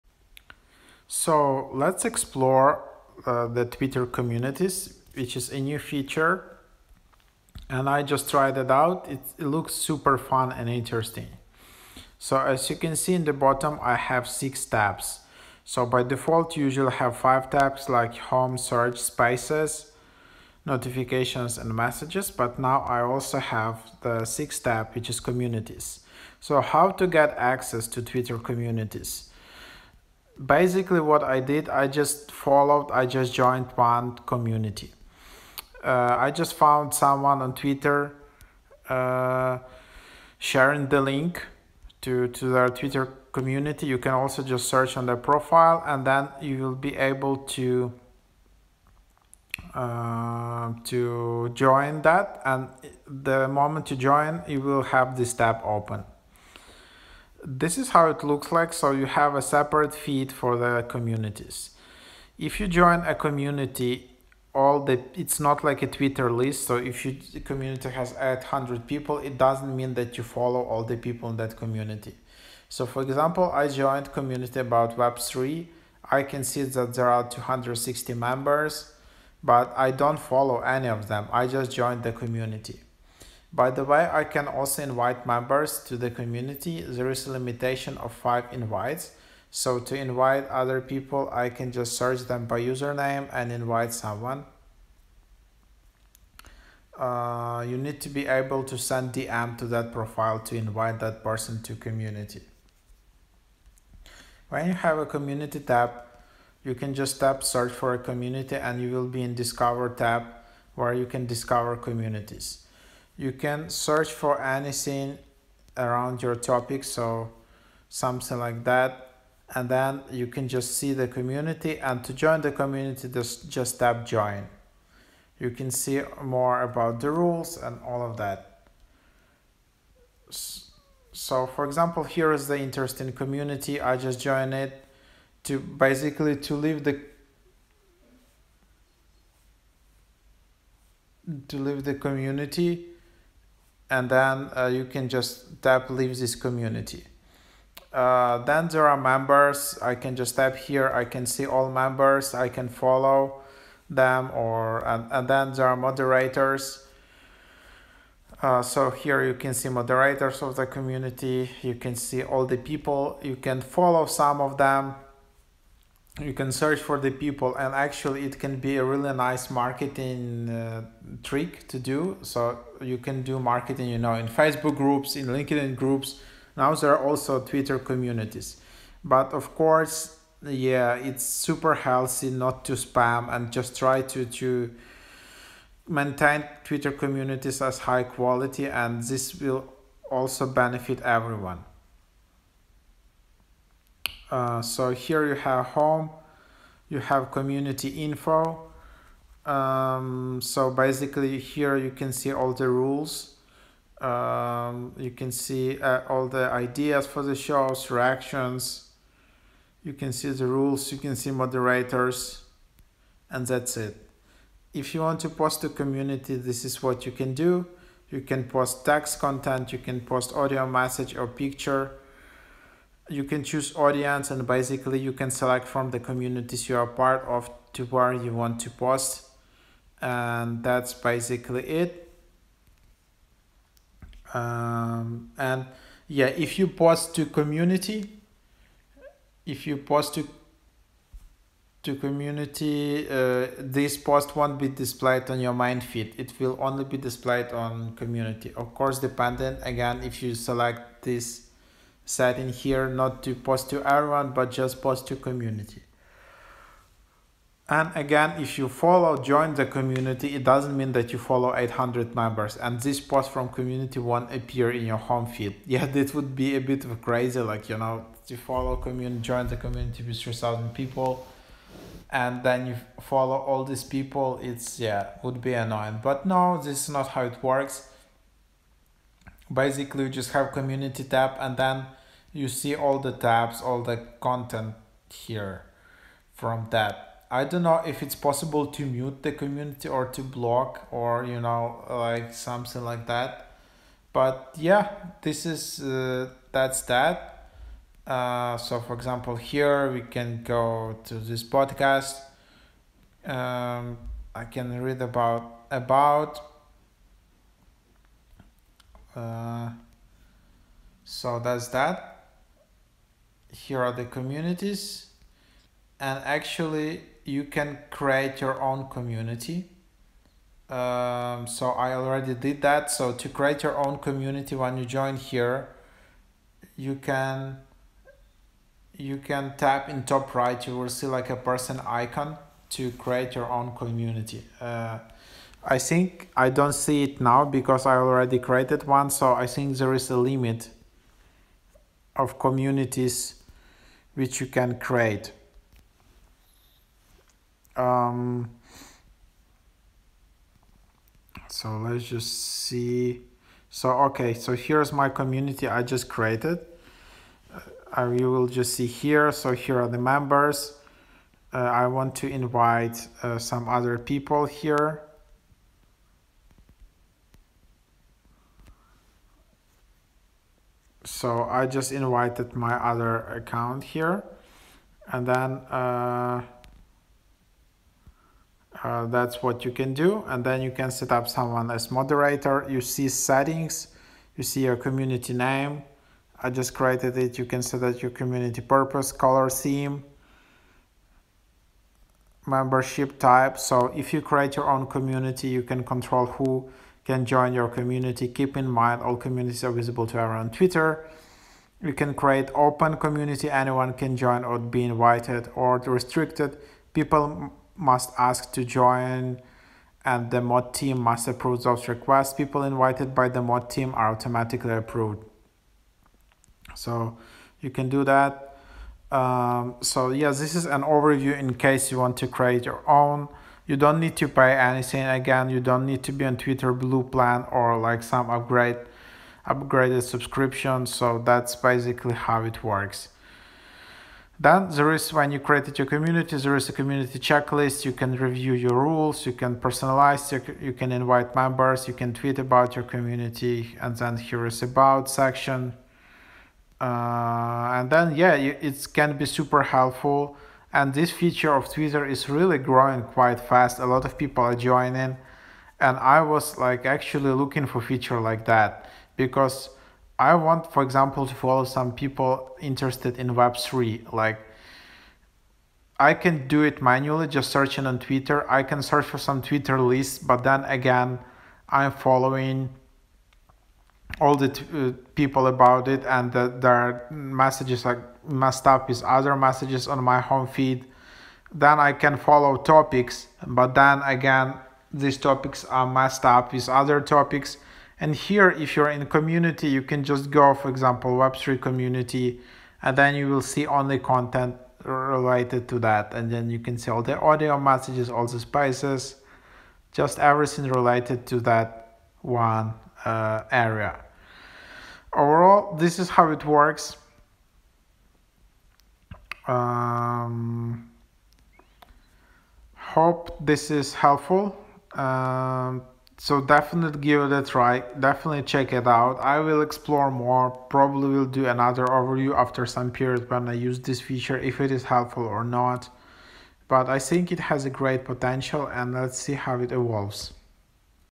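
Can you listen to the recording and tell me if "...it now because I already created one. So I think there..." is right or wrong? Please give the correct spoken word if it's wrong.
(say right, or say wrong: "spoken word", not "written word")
right.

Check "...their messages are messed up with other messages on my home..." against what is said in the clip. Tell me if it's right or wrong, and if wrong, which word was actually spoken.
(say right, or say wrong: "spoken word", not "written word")
right.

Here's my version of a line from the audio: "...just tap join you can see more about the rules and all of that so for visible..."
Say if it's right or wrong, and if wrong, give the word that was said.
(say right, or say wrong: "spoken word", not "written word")
wrong: "example", not "visible".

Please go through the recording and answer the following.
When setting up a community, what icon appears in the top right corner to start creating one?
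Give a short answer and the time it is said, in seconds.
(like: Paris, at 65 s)
person icon, at 331 s.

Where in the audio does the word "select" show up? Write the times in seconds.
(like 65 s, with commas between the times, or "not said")
225 s, 250 s.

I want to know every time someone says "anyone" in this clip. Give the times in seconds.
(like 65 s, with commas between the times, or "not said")
403 s.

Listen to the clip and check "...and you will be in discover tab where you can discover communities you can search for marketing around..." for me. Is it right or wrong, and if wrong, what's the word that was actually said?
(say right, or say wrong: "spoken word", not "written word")
wrong: "anything", not "marketing".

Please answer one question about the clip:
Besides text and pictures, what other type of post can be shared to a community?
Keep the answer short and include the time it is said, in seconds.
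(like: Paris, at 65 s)
audio message, at 220 s.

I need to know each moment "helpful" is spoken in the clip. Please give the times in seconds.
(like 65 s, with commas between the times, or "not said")
449 s, 513 s, 524 s.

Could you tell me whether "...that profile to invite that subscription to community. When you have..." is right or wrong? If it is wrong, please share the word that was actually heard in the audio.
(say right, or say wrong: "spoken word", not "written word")
wrong: "person", not "subscription".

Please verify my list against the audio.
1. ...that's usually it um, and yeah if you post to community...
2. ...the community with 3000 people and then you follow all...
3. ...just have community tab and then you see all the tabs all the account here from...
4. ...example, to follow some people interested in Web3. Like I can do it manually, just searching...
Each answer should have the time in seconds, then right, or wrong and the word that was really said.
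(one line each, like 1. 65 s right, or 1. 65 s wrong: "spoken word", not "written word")
1. 230 s wrong: "basically", not "usually"
2. 269 s right
3. 280 s wrong: "content", not "account"
4. 460 s right.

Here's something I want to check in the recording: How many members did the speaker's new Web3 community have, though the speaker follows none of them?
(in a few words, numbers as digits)
260.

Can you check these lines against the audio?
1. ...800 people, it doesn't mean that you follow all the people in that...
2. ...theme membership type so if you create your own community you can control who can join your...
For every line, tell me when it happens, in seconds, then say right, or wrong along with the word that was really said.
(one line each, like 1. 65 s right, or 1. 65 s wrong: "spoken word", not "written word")
1. 68 s right
2. 389 s right.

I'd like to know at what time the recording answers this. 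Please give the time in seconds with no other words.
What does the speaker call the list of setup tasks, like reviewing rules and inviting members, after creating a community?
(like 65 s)
436 s.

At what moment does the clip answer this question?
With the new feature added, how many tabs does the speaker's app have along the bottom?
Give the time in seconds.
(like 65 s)
14 s.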